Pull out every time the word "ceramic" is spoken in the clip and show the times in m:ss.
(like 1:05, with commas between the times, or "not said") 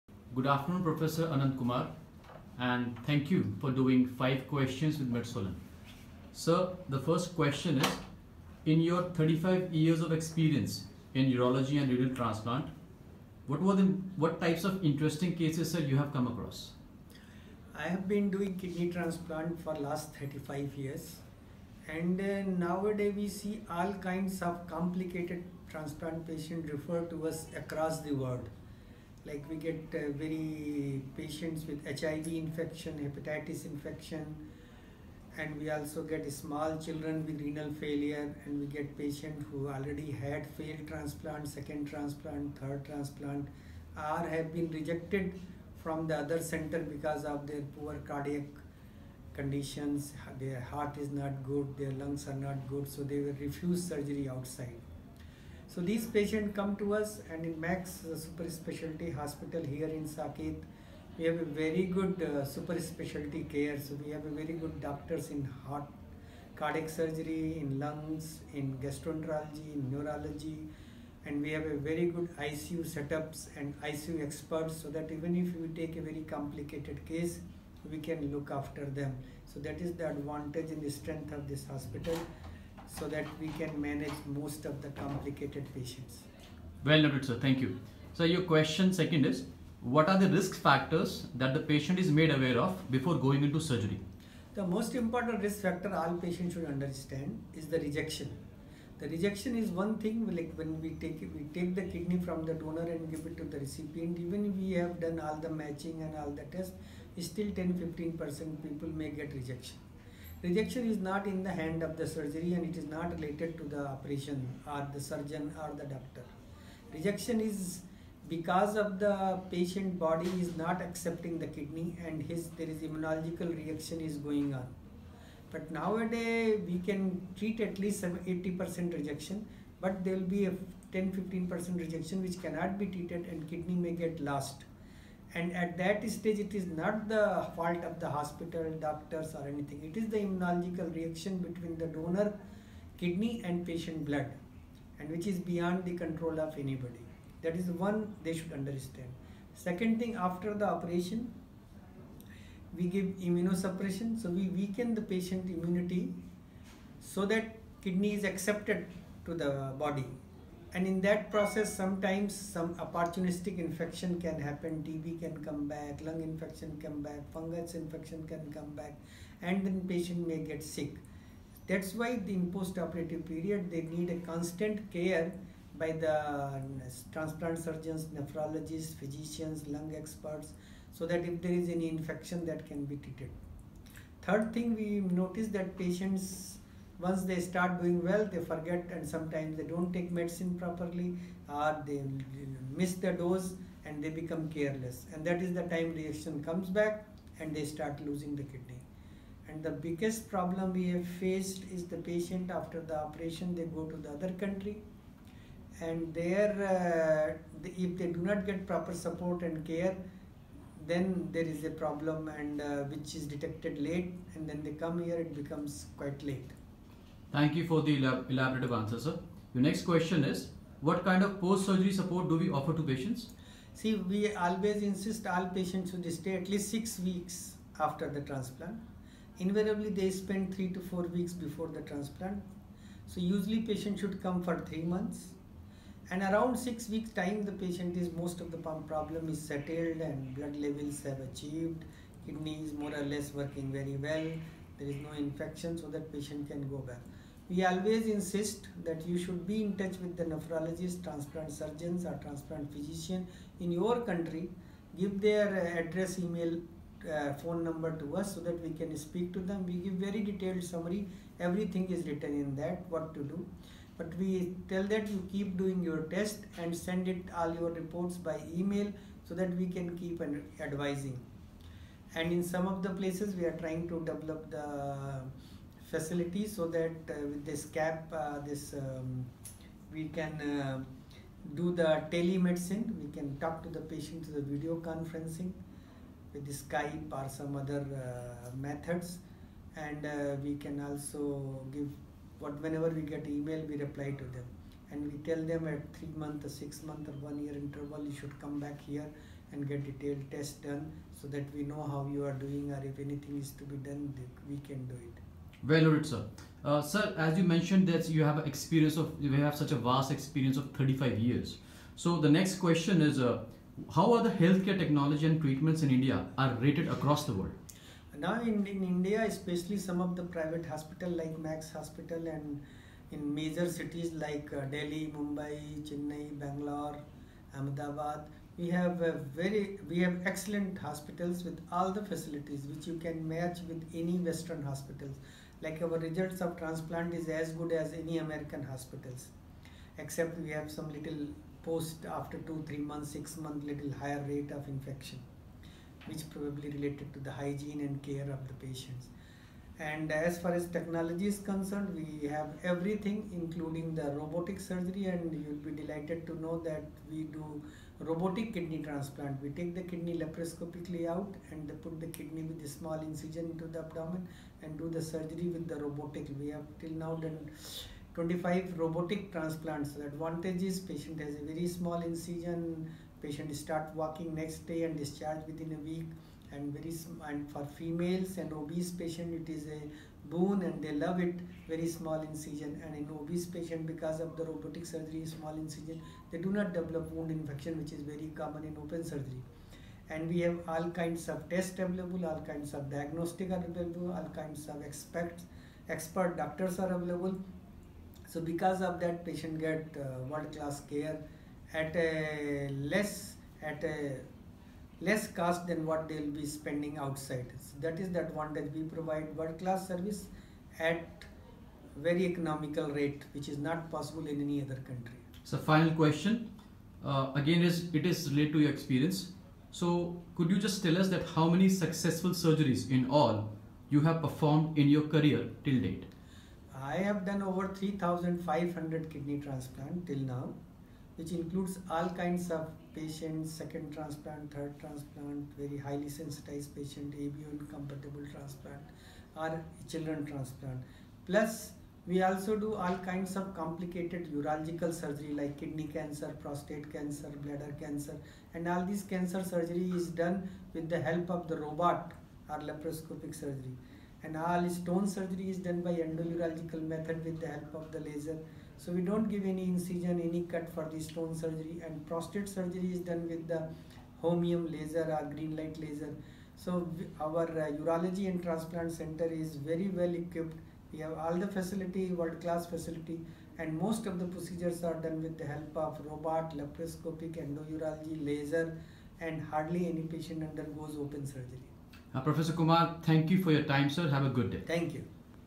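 not said.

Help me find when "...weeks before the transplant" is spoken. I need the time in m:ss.
3:51.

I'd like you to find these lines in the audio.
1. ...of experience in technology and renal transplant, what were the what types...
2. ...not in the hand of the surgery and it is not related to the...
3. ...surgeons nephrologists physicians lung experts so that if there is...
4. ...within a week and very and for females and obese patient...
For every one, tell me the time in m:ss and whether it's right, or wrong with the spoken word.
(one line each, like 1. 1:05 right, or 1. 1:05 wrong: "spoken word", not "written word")
1. 0:09 wrong: "urology", not "technology"
2. 1:50 right
3. 2:57 right
4. 6:15 right.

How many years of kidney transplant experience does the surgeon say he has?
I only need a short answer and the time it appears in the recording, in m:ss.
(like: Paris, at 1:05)
35, at 0:19.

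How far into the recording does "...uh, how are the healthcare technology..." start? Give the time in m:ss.
5:13.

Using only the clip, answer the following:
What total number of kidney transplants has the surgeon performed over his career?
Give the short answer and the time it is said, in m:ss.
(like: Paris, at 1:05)
over 3,500, at 7:07.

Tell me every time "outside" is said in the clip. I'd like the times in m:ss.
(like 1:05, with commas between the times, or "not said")
0:54, 6:46.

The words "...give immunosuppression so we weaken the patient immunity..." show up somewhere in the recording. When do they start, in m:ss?
2:32.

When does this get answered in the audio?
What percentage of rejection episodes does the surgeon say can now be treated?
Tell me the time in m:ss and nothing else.
2:08.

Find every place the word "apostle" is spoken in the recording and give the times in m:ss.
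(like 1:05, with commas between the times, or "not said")
not said.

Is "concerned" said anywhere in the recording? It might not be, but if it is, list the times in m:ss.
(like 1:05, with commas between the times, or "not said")
5:51.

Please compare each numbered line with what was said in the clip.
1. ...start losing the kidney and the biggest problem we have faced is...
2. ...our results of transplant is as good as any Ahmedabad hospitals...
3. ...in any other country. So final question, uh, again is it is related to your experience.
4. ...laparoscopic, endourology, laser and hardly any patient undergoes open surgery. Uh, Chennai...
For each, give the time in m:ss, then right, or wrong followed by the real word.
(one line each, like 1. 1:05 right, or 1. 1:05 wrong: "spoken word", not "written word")
1. 3:17 right
2. 5:35 wrong: "American", not "Ahmedabad"
3. 6:54 right
4. 7:56 wrong: "Professor", not "Chennai".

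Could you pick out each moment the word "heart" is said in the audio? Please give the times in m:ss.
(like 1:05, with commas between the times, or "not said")
0:50, 1:05.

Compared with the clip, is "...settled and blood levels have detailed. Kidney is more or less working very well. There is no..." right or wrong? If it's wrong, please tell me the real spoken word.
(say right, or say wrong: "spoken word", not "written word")
wrong: "achieved", not "detailed".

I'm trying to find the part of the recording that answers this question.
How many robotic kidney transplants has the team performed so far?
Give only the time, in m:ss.
6:08.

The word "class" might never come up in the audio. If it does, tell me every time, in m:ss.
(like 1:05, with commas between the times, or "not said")
6:40, 6:49, 7:52.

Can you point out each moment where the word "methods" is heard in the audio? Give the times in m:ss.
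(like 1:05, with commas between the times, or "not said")
4:48, 7:36.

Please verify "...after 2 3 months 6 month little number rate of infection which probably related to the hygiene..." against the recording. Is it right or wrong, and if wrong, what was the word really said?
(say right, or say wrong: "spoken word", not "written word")
wrong: "higher", not "number".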